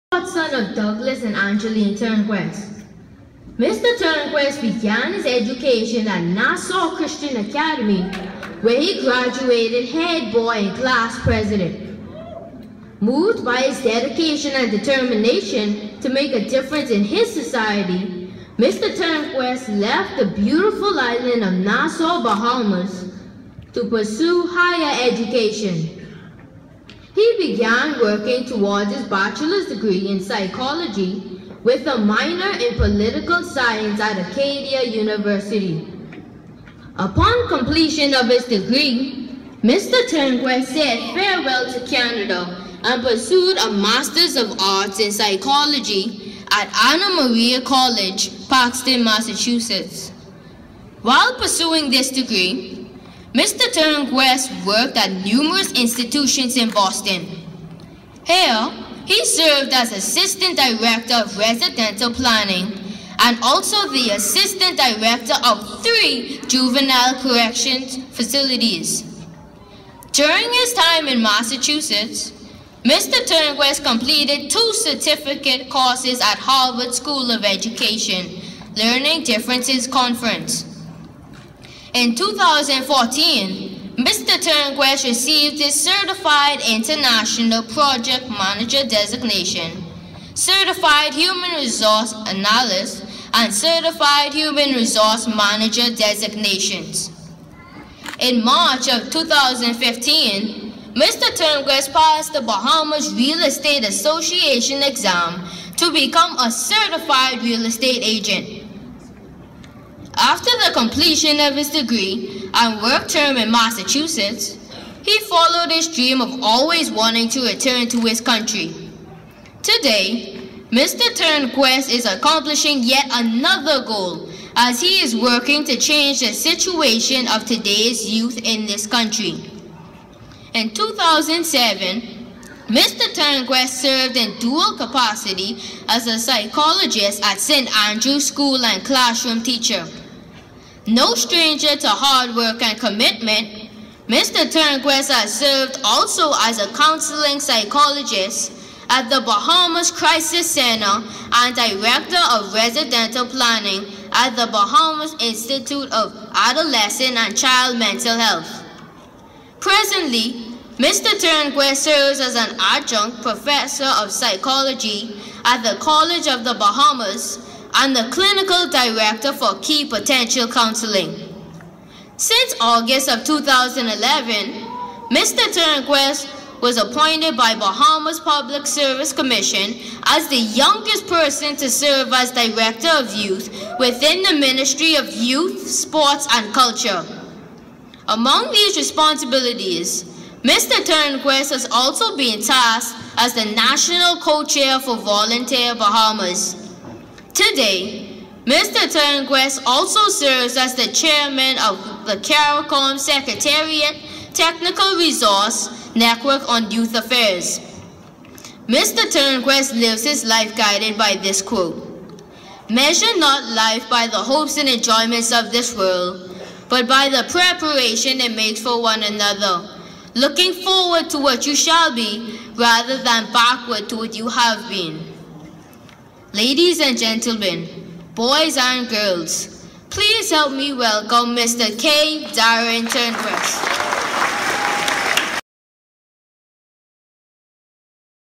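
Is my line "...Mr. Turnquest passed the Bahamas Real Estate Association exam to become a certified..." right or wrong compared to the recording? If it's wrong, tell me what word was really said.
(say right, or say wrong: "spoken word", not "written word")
right.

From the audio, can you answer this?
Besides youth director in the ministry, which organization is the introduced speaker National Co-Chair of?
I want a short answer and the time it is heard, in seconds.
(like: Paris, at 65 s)
Volunteer Bahamas, at 194 s.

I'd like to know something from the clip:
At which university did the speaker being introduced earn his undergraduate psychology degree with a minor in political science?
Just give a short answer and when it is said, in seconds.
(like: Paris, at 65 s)
Acadia University, at 34 s.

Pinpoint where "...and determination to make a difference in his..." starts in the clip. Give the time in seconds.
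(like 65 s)
14 s.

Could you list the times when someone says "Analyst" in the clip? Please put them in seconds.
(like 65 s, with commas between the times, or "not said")
92 s.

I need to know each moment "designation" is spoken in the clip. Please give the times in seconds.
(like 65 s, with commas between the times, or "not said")
88 s, 95 s.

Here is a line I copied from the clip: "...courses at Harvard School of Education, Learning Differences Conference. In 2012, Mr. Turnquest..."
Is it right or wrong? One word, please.
wrong.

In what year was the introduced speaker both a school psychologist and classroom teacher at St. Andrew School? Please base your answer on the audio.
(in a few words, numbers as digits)
2007.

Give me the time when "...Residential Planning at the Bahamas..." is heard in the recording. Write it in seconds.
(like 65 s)
152 s.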